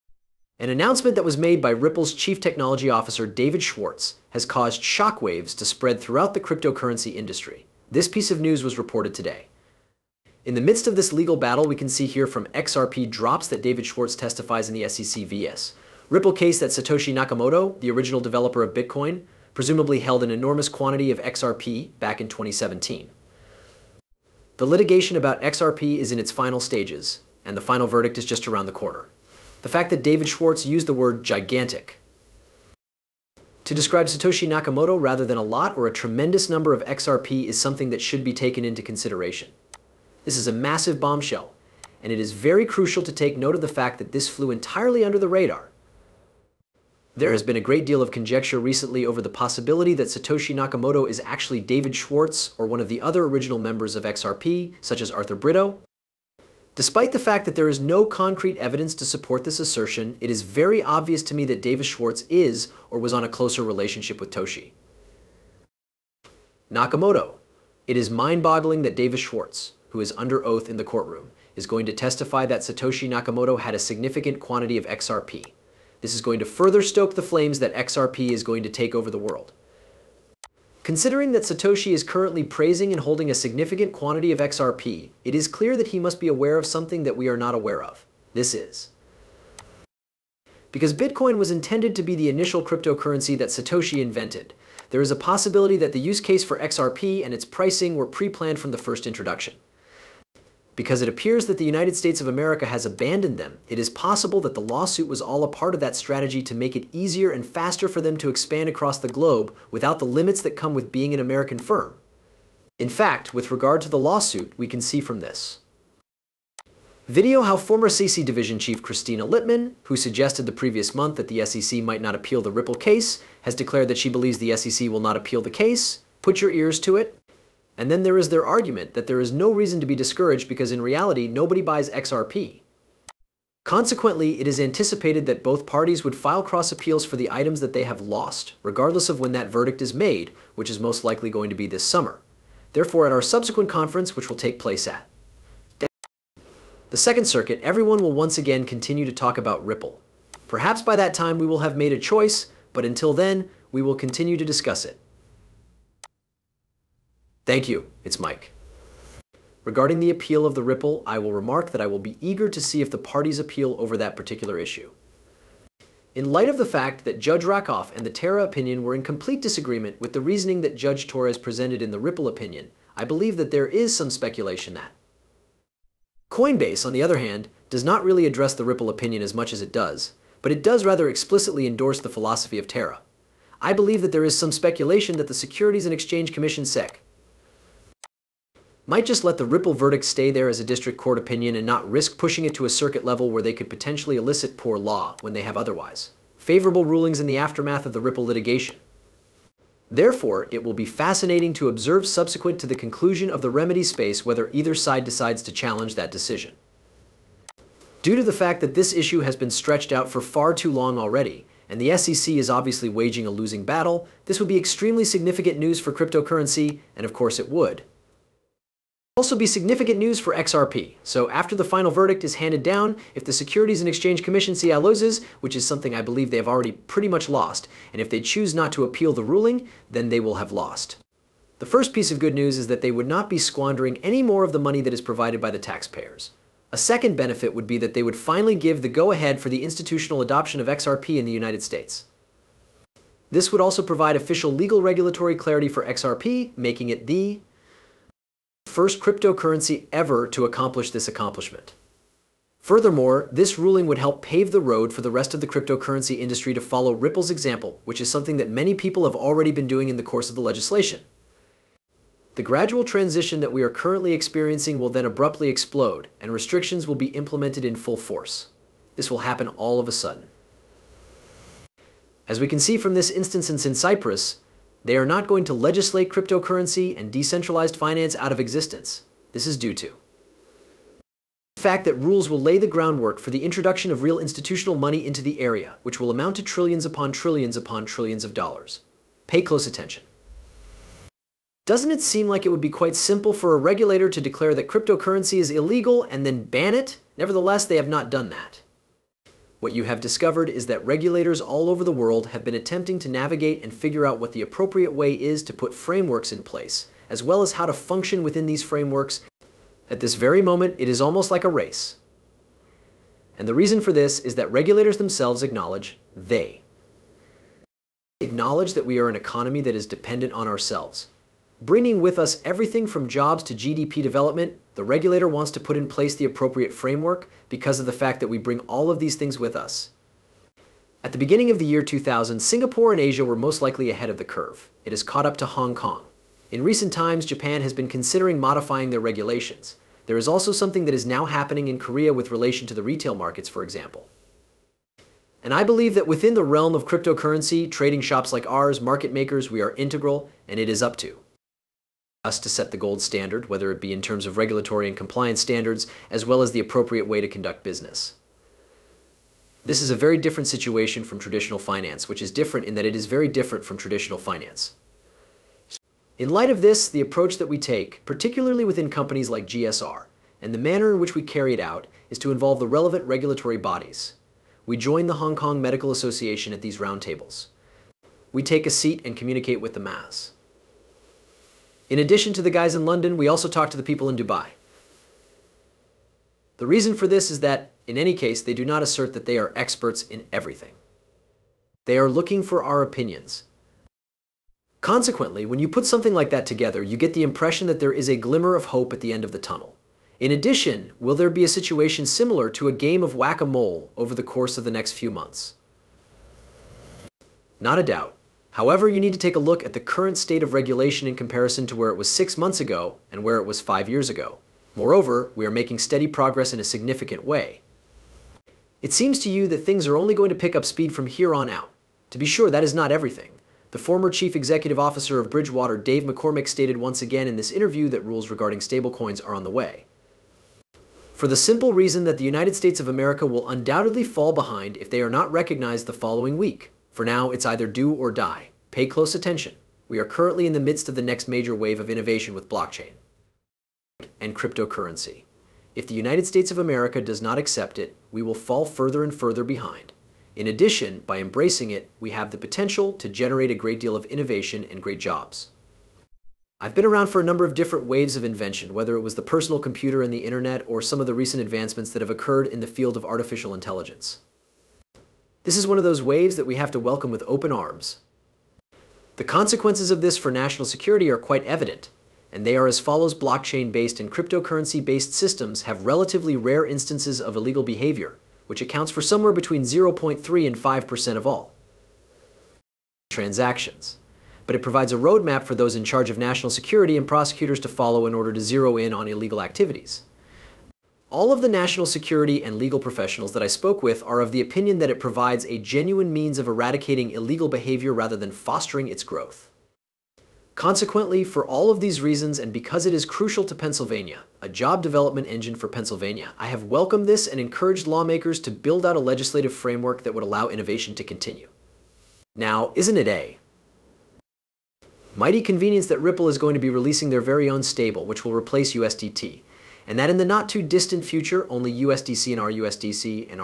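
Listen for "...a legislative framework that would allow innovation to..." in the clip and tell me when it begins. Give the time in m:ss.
8:28.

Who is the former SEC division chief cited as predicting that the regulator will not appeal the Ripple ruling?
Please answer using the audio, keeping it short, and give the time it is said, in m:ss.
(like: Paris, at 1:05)
Kristina Littman, at 1:58.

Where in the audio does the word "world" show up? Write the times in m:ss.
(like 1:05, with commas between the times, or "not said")
1:19, 5:01.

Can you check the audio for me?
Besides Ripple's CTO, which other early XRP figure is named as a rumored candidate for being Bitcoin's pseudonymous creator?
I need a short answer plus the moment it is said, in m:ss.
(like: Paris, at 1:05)
Arthur Brito, at 0:55.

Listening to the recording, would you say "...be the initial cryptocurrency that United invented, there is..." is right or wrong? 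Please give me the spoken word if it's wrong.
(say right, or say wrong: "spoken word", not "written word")
wrong: "Satoshi", not "United".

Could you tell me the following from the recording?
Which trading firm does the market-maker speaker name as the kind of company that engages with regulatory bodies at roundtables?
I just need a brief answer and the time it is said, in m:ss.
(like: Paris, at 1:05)
GSR, at 6:09.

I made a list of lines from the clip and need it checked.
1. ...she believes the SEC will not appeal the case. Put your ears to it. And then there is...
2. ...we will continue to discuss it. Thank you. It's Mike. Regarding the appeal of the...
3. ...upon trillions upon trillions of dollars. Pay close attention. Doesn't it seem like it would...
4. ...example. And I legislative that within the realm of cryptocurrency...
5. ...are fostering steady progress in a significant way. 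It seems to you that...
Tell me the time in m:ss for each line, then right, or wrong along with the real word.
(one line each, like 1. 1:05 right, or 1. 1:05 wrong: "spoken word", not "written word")
1. 2:03 right
2. 2:33 right
3. 4:46 right
4. 5:43 wrong: "believe", not "legislative"
5. 6:55 wrong: "making", not "fostering".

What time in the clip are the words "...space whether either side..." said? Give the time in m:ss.
3:23.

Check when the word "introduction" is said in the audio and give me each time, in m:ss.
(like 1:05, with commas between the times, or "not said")
1:39, 4:43.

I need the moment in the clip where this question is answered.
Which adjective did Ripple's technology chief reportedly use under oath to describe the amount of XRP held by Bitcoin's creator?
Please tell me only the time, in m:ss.
0:31.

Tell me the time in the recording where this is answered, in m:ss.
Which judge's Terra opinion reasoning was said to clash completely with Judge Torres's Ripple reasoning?
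2:47.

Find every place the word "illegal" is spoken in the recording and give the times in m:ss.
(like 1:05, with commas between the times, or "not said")
4:55, 7:57, 8:09, 8:17.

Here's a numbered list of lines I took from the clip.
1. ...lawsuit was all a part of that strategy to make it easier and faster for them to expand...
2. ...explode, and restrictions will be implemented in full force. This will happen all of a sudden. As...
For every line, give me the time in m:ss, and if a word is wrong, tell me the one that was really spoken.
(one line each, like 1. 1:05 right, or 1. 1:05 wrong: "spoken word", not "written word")
1. 1:44 right
2. 4:25 right.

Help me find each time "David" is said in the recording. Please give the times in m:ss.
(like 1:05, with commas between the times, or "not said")
0:03, 0:13, 0:30, 0:51, 1:01, 1:08.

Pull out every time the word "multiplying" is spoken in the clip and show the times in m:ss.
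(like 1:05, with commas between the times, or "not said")
not said.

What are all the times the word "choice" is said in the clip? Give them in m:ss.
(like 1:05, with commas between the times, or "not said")
2:31.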